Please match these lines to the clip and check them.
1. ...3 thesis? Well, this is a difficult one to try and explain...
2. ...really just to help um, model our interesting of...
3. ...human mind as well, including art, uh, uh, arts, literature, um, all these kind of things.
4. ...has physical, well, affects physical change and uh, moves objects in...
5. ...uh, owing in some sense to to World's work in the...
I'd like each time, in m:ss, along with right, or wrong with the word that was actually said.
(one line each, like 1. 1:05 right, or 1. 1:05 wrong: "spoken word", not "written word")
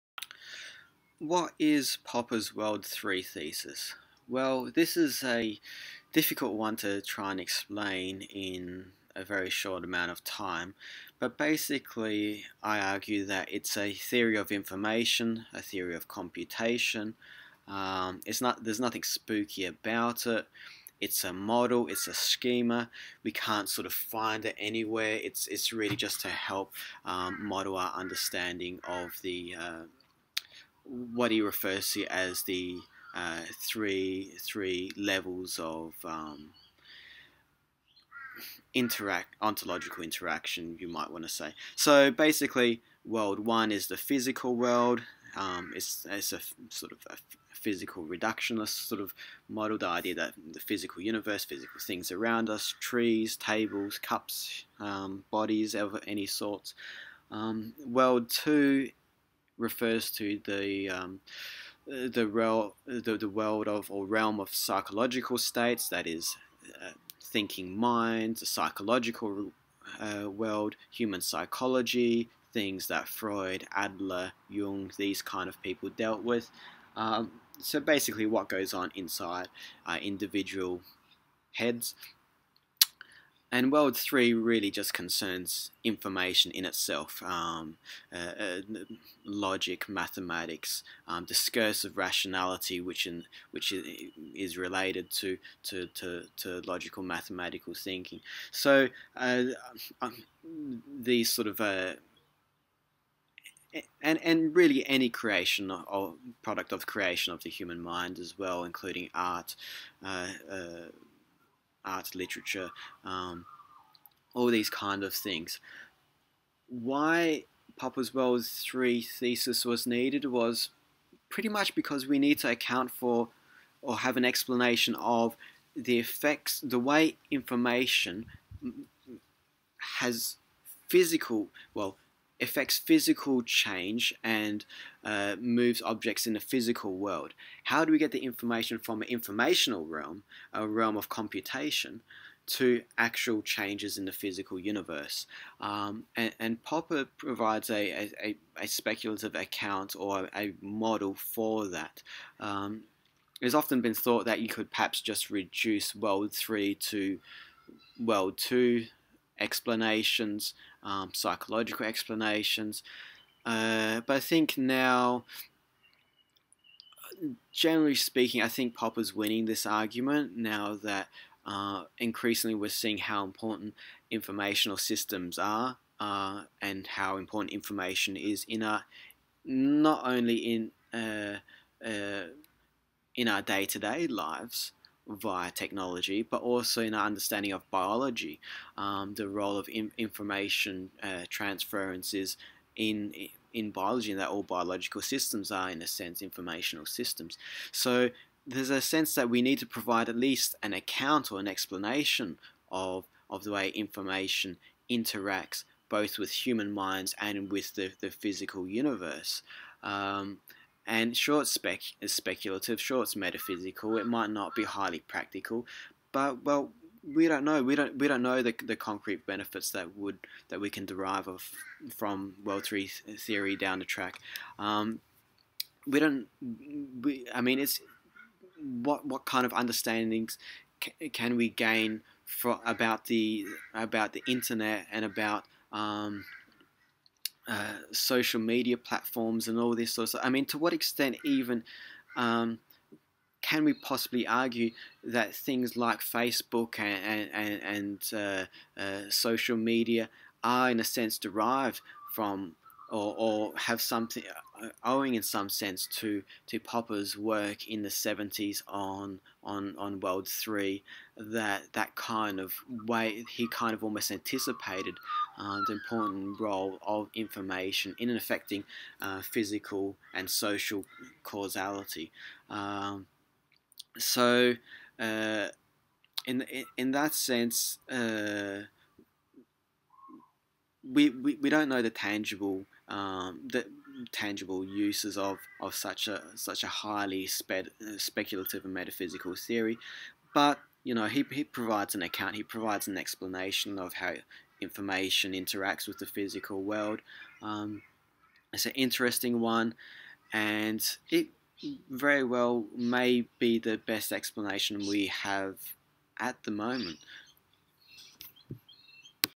1. 0:02 right
2. 0:25 wrong: "understanding", not "interesting"
3. 1:47 right
4. 2:09 right
5. 4:14 wrong: "Popper", not "World".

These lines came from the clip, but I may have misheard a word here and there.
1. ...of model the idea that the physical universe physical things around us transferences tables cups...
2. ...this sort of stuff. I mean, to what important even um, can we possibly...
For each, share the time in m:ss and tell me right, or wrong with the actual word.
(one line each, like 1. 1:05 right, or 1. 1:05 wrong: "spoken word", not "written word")
1. 0:48 wrong: "trees", not "transferences"
2. 3:59 wrong: "extent", not "important".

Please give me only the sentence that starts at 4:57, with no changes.
Um, it's an interesting one, and it very well may be the best explanation we have at the moment.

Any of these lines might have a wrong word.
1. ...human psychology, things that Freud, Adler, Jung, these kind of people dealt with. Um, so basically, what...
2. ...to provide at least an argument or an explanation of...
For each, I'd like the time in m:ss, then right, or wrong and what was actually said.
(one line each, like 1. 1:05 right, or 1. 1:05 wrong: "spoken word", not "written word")
1. 1:10 right
2. 3:19 wrong: "account", not "argument".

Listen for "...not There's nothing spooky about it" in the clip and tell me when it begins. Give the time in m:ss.
0:18.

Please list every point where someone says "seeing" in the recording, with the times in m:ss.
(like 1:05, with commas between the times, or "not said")
2:52.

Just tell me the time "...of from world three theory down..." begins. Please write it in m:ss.
3:41.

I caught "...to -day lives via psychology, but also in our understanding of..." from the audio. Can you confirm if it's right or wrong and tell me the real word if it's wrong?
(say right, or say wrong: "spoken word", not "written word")
wrong: "technology", not "psychology".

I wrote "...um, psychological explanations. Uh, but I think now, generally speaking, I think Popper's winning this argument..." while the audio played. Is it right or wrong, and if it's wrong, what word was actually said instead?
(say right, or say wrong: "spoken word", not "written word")
right.